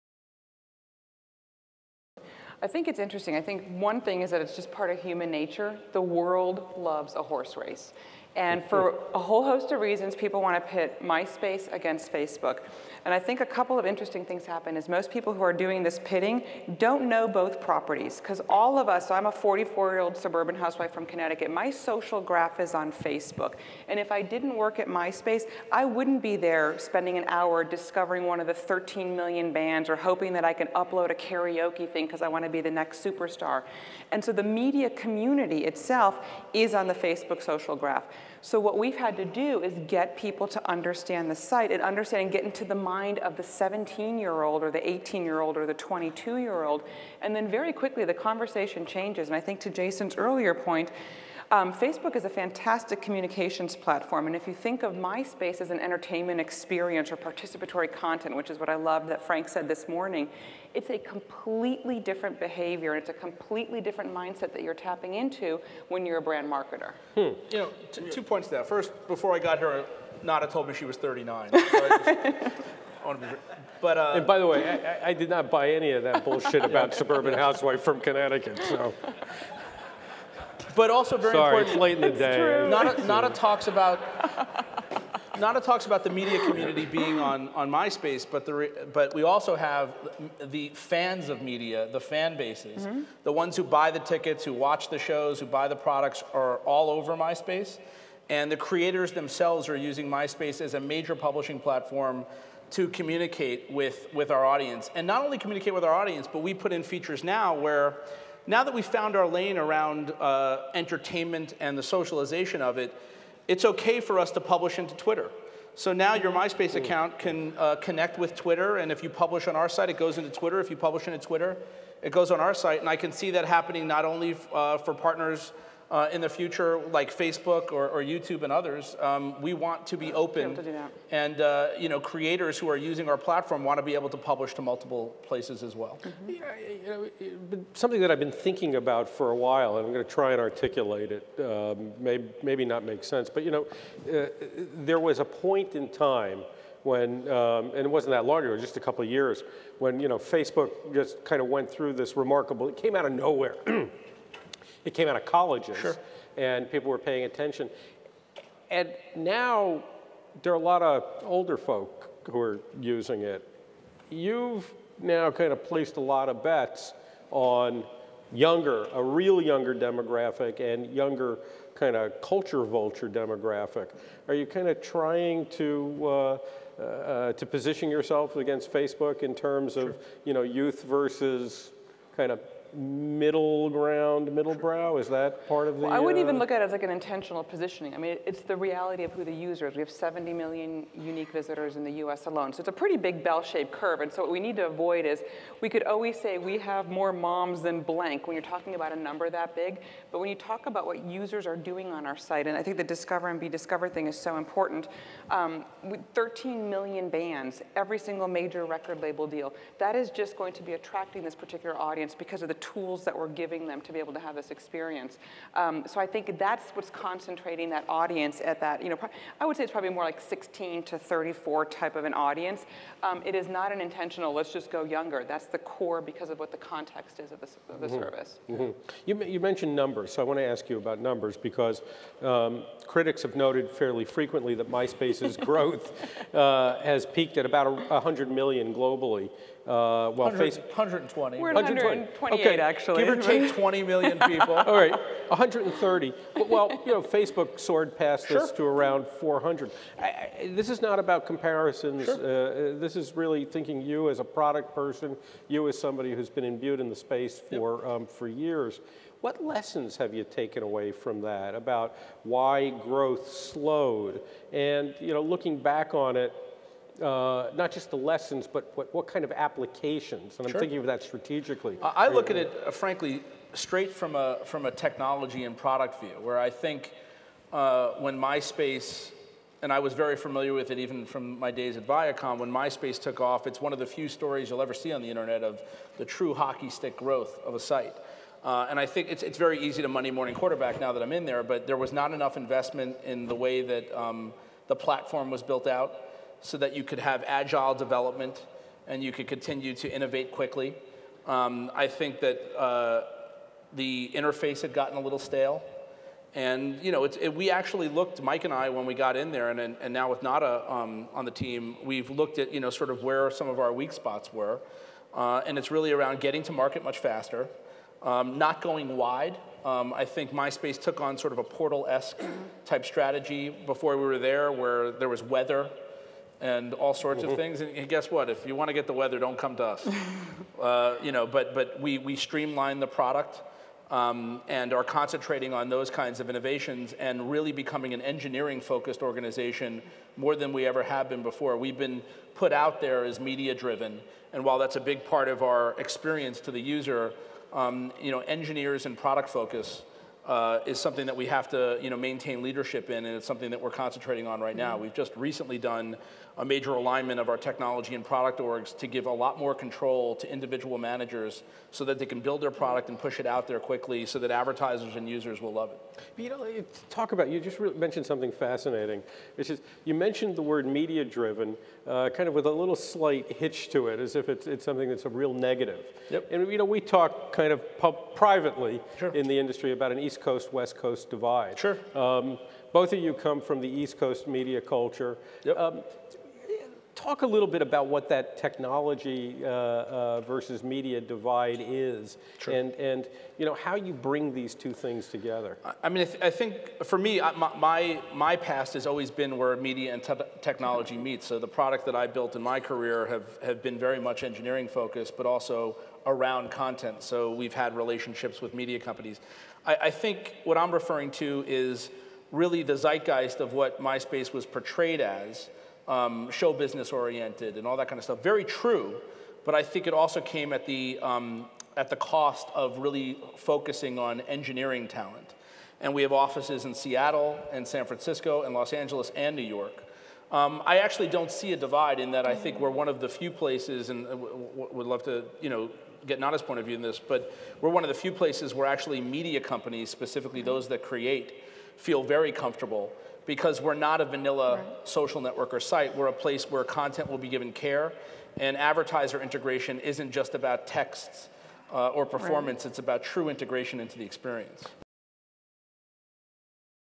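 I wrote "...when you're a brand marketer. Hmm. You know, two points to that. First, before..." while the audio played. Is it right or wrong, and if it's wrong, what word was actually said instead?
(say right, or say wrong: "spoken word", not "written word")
right.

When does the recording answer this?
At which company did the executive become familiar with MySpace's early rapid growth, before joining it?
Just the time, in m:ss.
4:41.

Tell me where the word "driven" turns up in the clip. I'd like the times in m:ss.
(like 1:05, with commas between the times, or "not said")
5:43, 6:11.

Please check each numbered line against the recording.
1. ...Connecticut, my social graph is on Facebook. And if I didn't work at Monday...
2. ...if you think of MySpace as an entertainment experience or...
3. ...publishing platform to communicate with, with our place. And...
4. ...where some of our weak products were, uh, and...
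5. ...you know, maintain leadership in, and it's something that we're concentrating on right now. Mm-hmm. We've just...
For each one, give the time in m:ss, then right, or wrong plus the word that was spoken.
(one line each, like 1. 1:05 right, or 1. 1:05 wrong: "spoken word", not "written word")
1. 0:21 wrong: "MySpace", not "Monday"
2. 0:54 right
3. 1:41 wrong: "audience", not "place"
4. 5:13 wrong: "spots", not "products"
5. 5:51 right.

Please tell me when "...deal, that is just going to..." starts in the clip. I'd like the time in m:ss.
3:29.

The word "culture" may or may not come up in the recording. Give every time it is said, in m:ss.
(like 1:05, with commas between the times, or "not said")
2:52, 6:24.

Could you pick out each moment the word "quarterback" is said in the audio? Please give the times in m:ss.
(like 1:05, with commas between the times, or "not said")
4:50.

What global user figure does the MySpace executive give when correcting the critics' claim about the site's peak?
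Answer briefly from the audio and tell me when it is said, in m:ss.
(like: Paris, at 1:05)
128 million, at 4:01.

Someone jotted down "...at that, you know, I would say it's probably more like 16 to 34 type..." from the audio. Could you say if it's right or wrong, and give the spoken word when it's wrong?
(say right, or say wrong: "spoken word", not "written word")
right.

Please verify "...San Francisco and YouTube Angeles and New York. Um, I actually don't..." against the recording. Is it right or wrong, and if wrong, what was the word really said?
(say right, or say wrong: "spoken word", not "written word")
wrong: "Los", not "YouTube".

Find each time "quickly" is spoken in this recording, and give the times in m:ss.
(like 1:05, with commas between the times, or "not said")
0:47, 5:00, 6:03.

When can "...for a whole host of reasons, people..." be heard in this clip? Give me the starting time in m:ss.
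0:08.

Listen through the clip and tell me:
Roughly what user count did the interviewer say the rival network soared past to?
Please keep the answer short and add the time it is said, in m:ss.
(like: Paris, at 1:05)
400 million, at 4:08.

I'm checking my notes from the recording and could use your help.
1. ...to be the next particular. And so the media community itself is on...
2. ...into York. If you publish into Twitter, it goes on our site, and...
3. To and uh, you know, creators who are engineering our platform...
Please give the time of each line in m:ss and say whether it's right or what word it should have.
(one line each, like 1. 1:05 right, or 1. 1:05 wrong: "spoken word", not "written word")
1. 0:32 wrong: "superstar", not "particular"
2. 2:00 wrong: "Twitter", not "York"
3. 2:10 wrong: "using", not "engineering".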